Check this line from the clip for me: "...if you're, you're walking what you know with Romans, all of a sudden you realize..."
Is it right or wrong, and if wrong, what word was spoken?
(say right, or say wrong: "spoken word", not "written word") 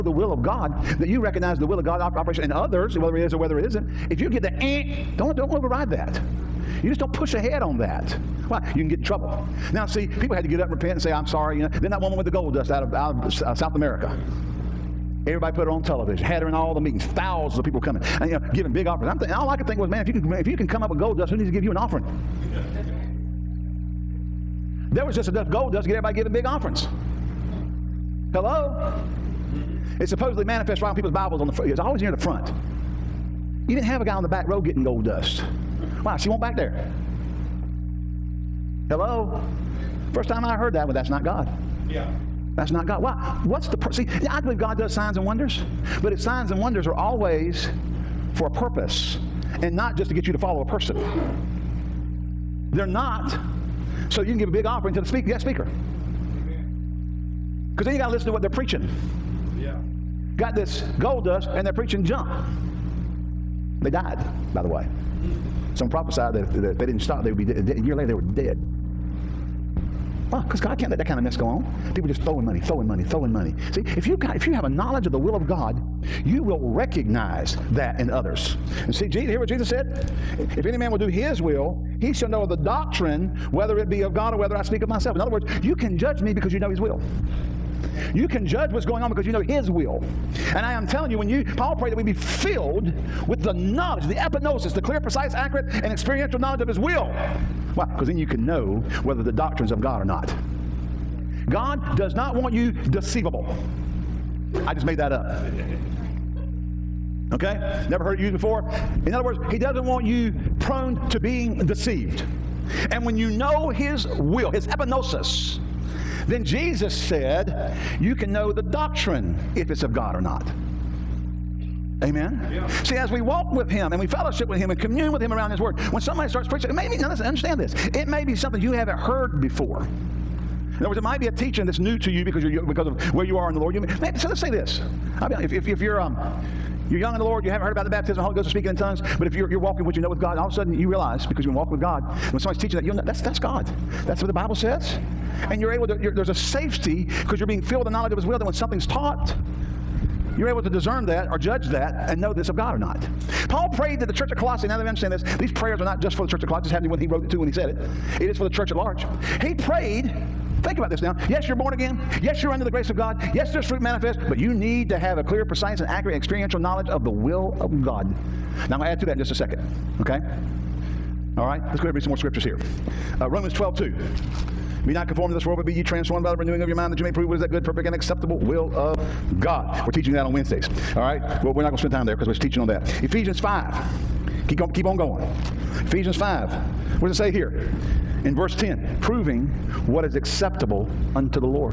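wrong: "God", not "Romans".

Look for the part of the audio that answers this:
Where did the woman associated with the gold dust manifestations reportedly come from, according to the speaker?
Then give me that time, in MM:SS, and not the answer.
00:13.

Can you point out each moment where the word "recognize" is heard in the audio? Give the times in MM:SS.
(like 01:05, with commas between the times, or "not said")
00:01, 01:16.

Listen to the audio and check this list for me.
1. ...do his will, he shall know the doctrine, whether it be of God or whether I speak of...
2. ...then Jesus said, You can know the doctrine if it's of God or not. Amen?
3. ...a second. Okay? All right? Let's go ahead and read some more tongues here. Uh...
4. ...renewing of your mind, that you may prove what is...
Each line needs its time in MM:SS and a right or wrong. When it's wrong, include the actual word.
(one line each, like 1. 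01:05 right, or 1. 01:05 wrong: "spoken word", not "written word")
1. 01:20 right
2. 01:56 right
3. 02:49 wrong: "scriptures", not "tongues"
4. 02:56 right.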